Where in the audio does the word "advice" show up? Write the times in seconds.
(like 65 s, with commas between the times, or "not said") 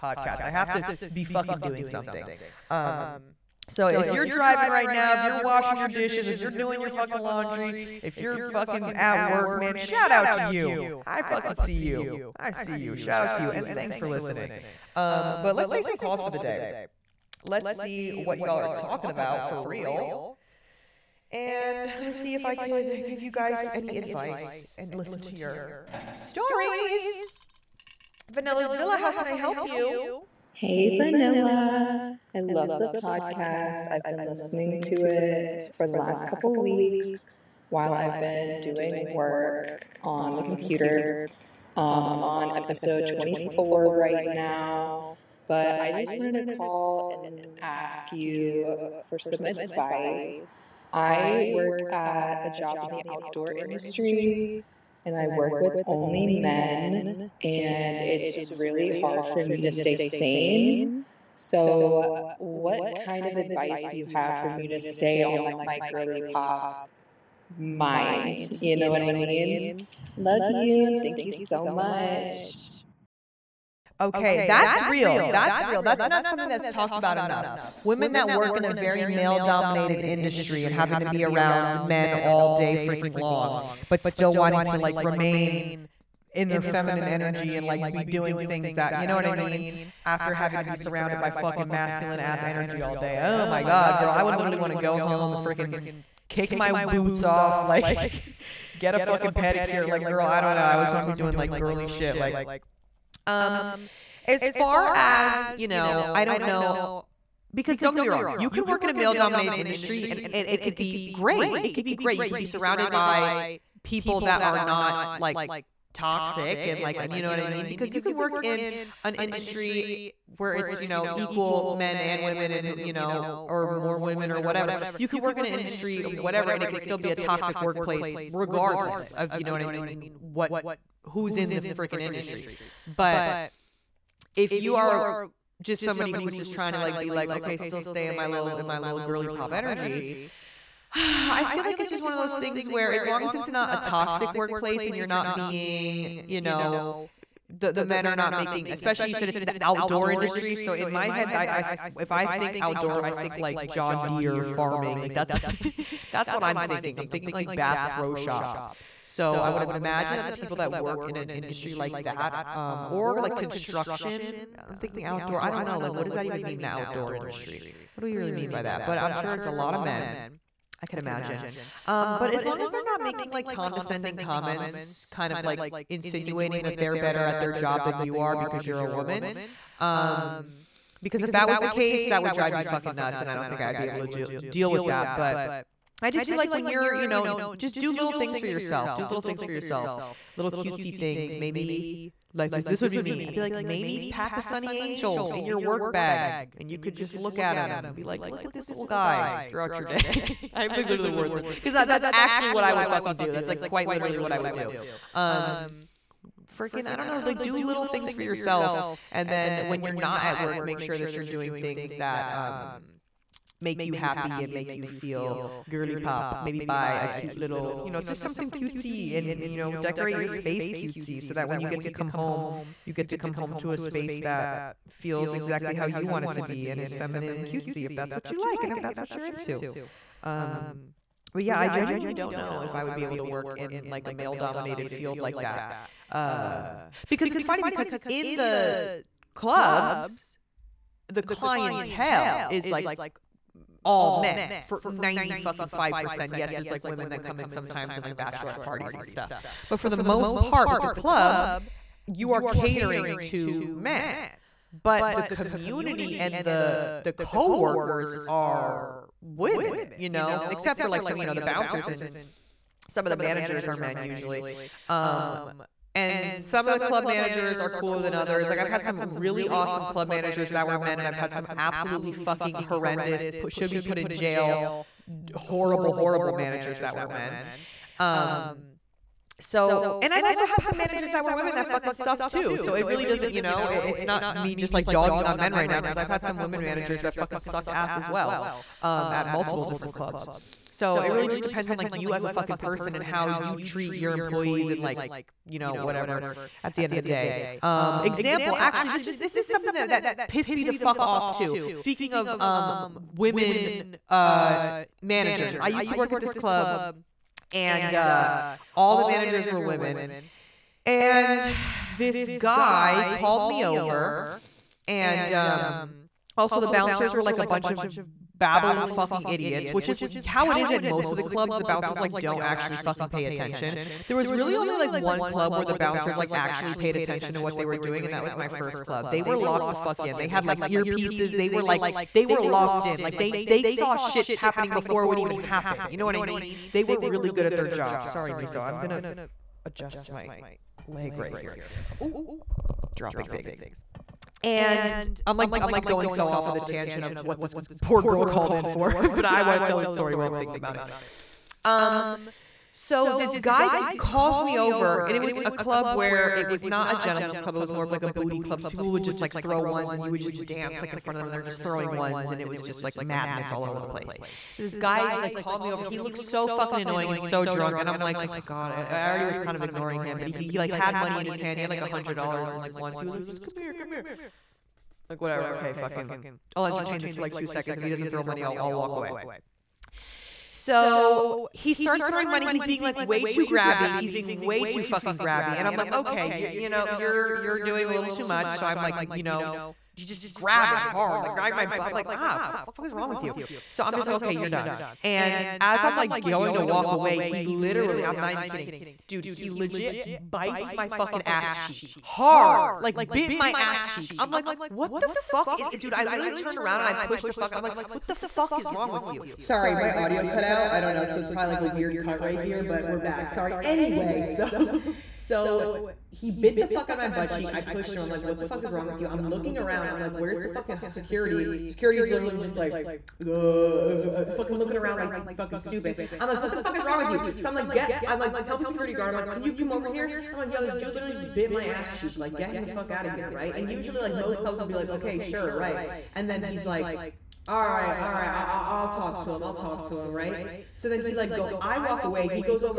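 23 s, 49 s, 63 s.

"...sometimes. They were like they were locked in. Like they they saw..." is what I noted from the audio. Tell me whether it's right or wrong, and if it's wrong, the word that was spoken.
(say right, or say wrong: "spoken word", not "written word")
wrong: "earpieces", not "sometimes".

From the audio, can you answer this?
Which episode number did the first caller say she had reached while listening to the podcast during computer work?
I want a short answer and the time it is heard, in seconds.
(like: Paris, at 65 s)
24, at 42 s.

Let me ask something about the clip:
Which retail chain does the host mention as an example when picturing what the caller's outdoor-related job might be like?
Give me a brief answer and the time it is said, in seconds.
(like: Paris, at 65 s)
Bass Pro Shops, at 157 s.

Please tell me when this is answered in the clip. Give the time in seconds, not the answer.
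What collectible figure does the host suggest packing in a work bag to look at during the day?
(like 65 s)
194 s.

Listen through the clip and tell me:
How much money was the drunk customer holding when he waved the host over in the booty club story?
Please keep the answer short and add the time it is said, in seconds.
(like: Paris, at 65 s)
$100, at 371 s.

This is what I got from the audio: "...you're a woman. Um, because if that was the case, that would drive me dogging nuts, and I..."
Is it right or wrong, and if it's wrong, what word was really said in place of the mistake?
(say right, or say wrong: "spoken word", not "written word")
wrong: "fucking", not "dogging".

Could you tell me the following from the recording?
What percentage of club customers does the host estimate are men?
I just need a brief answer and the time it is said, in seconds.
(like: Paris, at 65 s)
95%, at 244 s.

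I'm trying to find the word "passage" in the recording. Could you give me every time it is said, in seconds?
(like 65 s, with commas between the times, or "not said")
not said.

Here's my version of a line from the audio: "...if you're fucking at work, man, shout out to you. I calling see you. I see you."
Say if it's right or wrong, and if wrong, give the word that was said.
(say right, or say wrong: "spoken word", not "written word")
wrong: "fucking", not "calling".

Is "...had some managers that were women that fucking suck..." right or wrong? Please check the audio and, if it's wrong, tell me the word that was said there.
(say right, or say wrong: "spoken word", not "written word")
right.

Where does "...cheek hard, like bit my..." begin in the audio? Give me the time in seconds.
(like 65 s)
401 s.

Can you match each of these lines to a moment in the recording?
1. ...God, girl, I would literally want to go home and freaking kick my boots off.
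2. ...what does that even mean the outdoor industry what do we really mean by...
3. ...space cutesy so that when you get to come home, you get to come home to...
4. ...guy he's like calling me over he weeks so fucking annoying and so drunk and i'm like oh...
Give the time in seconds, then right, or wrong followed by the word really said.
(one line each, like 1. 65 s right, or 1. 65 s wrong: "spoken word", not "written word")
1. 93 s right
2. 165 s right
3. 220 s right
4. 364 s wrong: "looks", not "weeks".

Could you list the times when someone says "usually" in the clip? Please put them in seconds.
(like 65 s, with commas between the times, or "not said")
263 s, 433 s.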